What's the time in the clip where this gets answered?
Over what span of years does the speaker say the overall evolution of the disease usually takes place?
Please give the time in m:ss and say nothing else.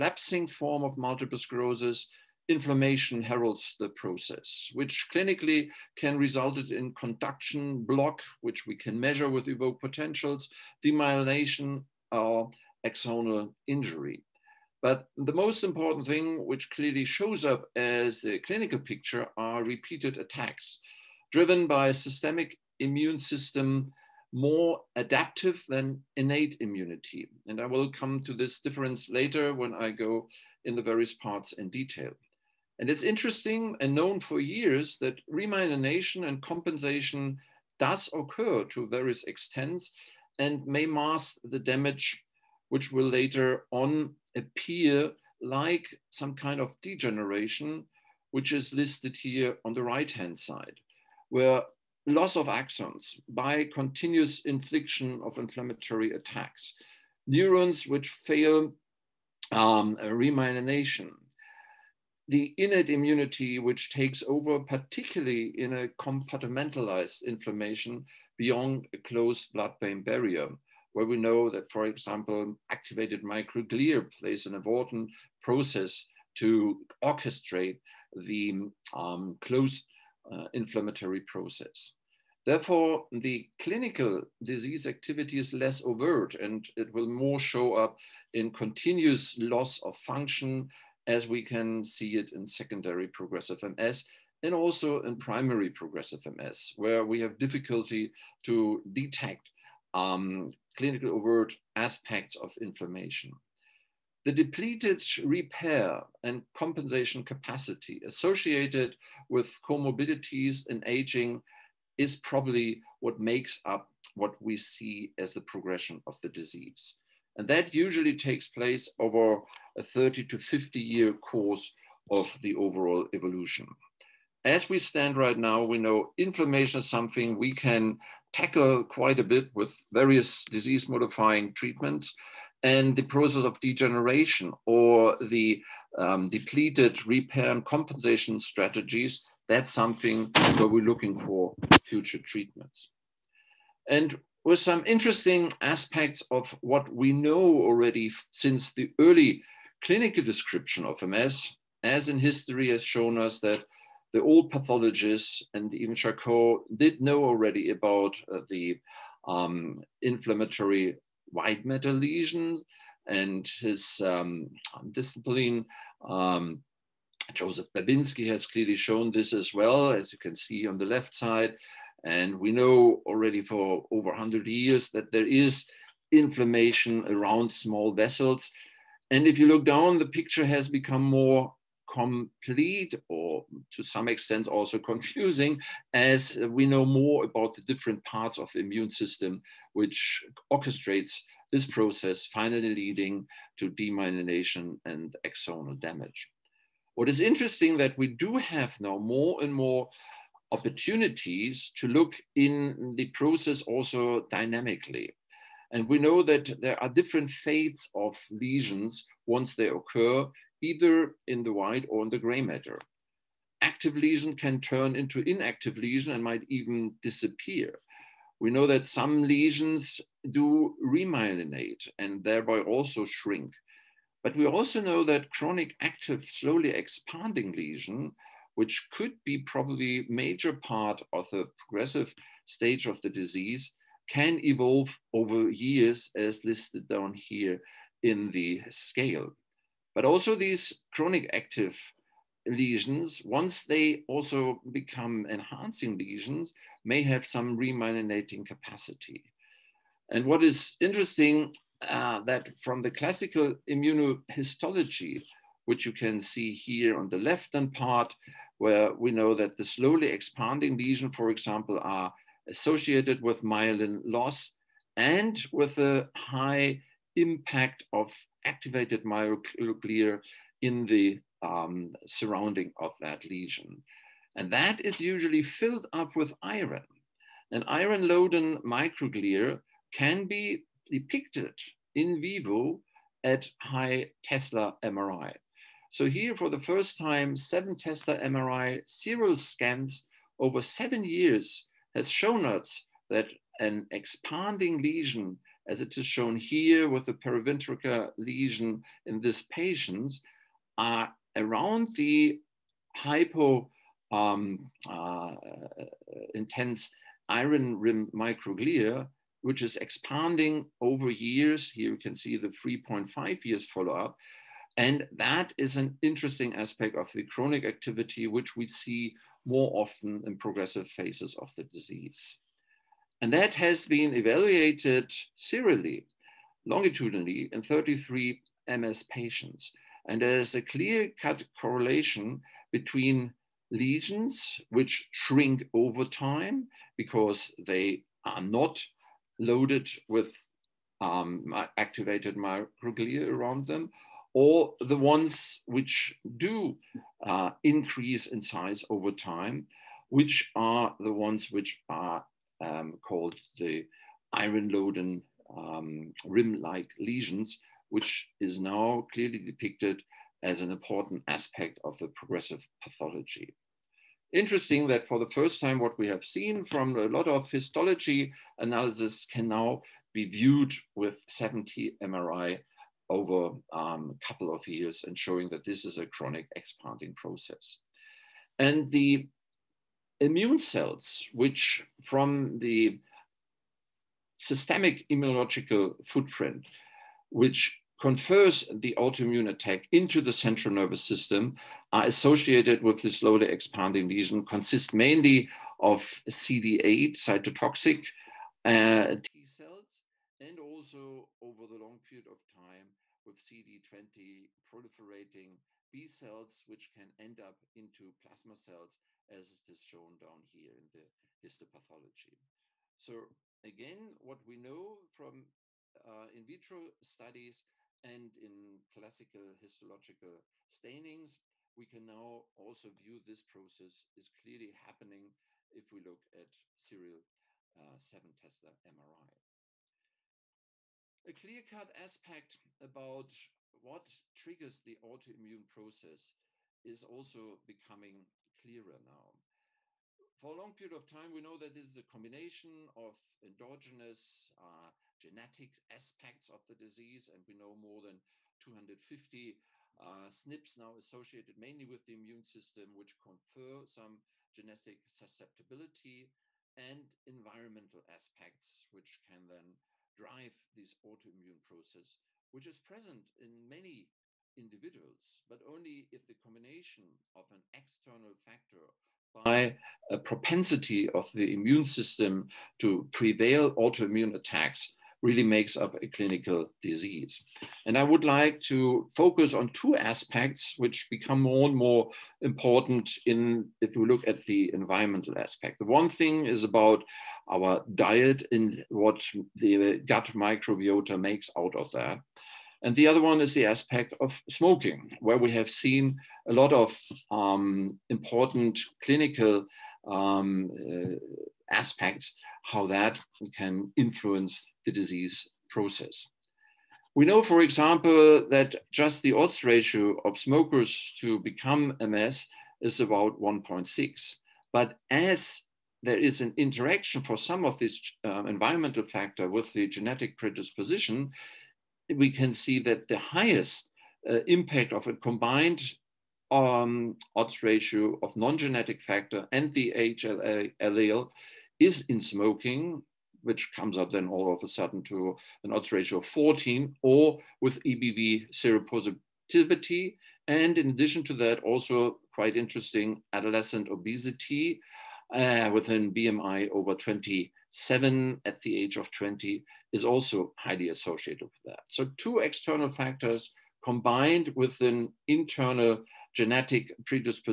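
1:59.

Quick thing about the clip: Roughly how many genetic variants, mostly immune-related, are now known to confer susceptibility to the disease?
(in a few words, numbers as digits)
more than 250.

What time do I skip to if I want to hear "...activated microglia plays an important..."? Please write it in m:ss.
1:12.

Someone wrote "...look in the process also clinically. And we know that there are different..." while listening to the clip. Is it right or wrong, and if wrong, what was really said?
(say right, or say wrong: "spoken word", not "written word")
wrong: "dynamically", not "clinically".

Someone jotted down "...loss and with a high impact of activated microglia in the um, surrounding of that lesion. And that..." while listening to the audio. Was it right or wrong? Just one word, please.
right.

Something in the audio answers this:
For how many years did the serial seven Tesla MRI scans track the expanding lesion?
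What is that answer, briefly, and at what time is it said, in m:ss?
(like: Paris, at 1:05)
7 years, at 4:50.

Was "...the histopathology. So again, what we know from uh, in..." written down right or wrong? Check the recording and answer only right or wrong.
right.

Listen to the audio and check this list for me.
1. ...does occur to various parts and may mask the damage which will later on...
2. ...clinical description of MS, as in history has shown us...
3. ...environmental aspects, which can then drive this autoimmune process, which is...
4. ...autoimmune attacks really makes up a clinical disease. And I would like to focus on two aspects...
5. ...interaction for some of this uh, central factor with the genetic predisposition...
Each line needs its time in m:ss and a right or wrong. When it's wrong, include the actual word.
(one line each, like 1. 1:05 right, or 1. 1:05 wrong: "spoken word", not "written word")
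1. 0:37 wrong: "extents", not "parts"
2. 2:29 right
3. 7:37 right
4. 7:53 right
5. 8:36 wrong: "environmental", not "central".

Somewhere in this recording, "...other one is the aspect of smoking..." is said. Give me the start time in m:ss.
8:13.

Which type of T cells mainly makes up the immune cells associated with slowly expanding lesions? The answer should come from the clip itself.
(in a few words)
CD8 cytotoxic T cells.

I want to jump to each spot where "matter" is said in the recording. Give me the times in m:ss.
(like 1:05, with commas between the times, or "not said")
2:41, 3:32.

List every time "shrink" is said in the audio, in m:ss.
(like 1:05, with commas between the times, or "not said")
3:43, 5:35.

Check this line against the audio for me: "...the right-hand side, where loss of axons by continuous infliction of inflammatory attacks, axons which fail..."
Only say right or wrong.
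wrong.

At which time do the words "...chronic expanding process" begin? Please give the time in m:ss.
6:16.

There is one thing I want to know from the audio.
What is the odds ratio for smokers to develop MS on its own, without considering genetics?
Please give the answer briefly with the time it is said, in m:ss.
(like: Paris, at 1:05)
1.6, at 8:33.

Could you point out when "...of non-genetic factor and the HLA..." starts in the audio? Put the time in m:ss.
8:48.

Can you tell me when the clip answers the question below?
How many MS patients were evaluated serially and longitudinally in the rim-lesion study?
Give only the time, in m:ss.
5:27.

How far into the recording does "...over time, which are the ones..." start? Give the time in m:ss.
5:48.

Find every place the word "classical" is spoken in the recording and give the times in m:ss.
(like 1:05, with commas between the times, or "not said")
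4:12, 6:58.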